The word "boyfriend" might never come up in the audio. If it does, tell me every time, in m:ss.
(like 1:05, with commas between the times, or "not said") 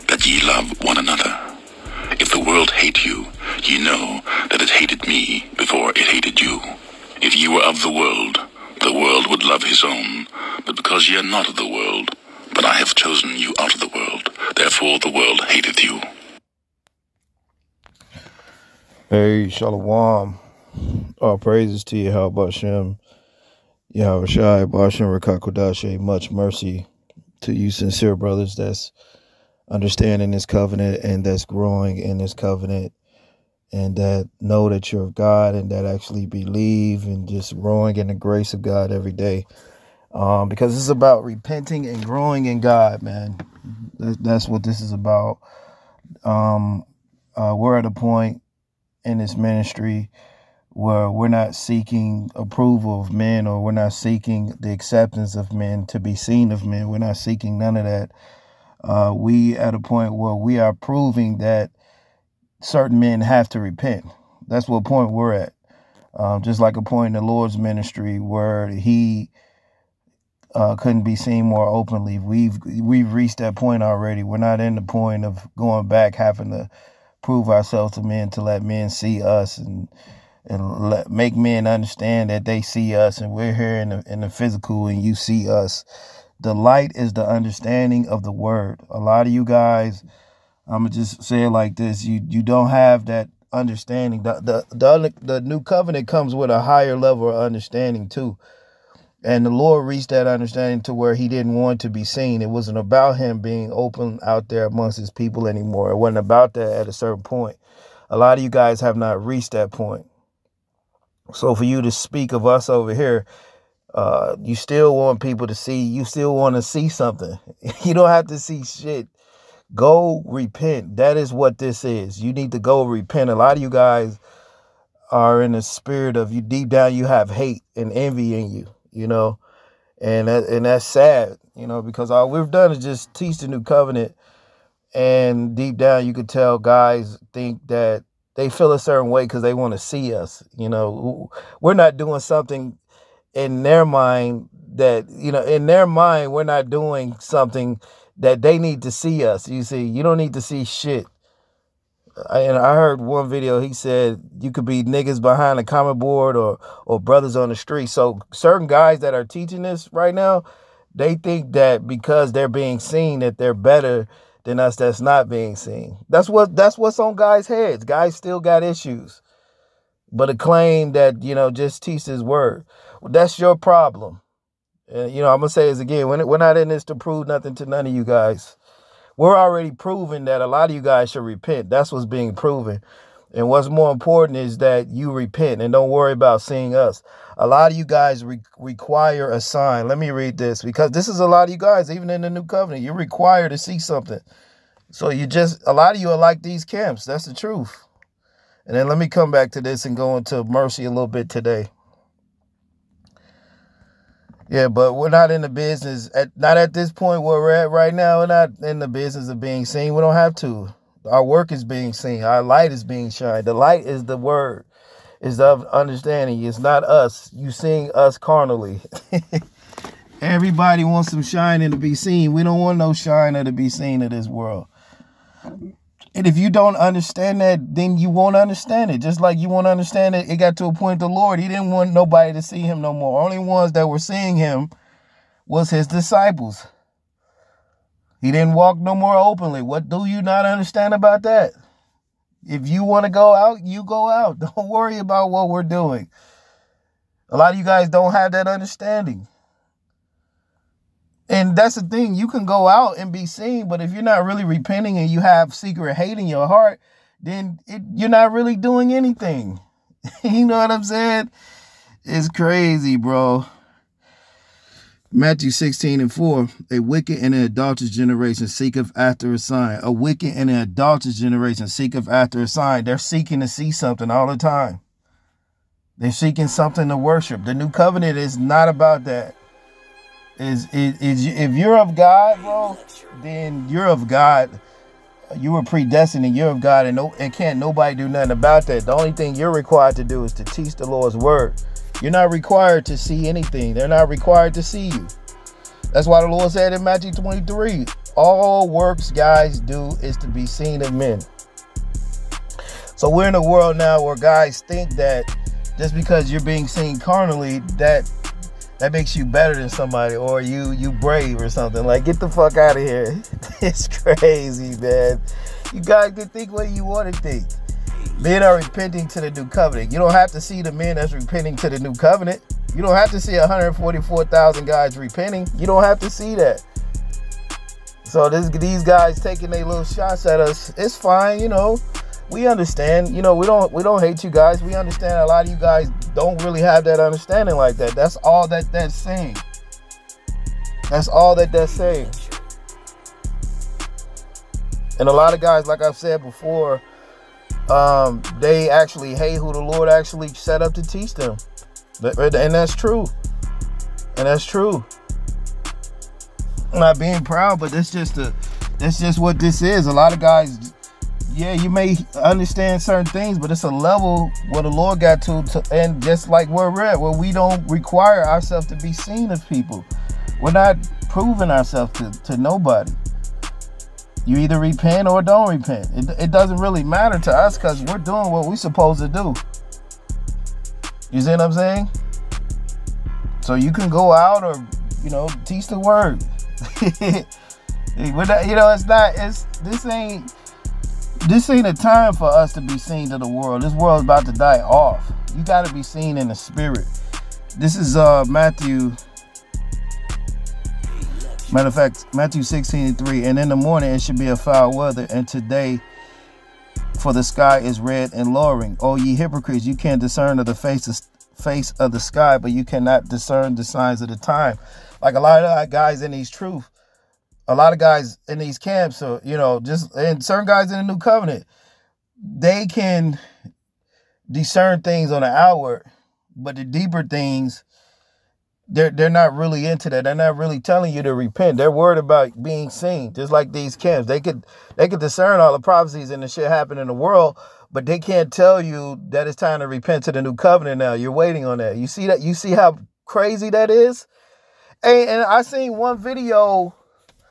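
not said.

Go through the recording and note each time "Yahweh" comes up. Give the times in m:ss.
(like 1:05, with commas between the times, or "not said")
0:23.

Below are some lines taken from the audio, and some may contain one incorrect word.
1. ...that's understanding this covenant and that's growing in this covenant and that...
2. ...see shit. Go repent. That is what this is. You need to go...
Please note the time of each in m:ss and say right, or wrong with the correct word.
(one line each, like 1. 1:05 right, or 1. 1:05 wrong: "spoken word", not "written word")
1. 0:28 right
2. 1:58 right.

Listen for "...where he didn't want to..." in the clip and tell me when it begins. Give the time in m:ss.
1:40.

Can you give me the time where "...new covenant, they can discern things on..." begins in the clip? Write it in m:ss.
7:00.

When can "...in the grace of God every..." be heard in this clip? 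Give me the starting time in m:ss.
0:37.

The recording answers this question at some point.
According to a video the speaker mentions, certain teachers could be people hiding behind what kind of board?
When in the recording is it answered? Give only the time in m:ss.
2:35.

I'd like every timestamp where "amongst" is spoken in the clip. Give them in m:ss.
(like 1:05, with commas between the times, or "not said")
1:44.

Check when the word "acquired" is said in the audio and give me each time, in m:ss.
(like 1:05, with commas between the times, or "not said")
not said.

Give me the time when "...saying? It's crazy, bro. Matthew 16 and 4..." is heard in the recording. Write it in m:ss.
4:20.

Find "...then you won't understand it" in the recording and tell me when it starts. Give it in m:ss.
3:47.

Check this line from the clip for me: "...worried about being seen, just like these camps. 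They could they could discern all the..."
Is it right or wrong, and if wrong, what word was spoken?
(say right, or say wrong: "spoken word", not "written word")
right.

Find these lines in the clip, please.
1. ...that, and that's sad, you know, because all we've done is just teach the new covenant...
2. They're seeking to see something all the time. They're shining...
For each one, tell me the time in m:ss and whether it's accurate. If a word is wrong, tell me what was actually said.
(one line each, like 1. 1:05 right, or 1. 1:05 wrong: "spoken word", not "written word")
1. 2:10 right
2. 4:32 wrong: "seeking", not "shining".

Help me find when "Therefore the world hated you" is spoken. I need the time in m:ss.
0:14.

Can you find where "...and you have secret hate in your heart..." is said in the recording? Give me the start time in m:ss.
4:14.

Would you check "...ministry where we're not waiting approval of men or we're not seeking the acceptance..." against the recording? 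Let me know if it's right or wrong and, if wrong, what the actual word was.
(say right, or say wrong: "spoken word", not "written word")
wrong: "seeking", not "waiting".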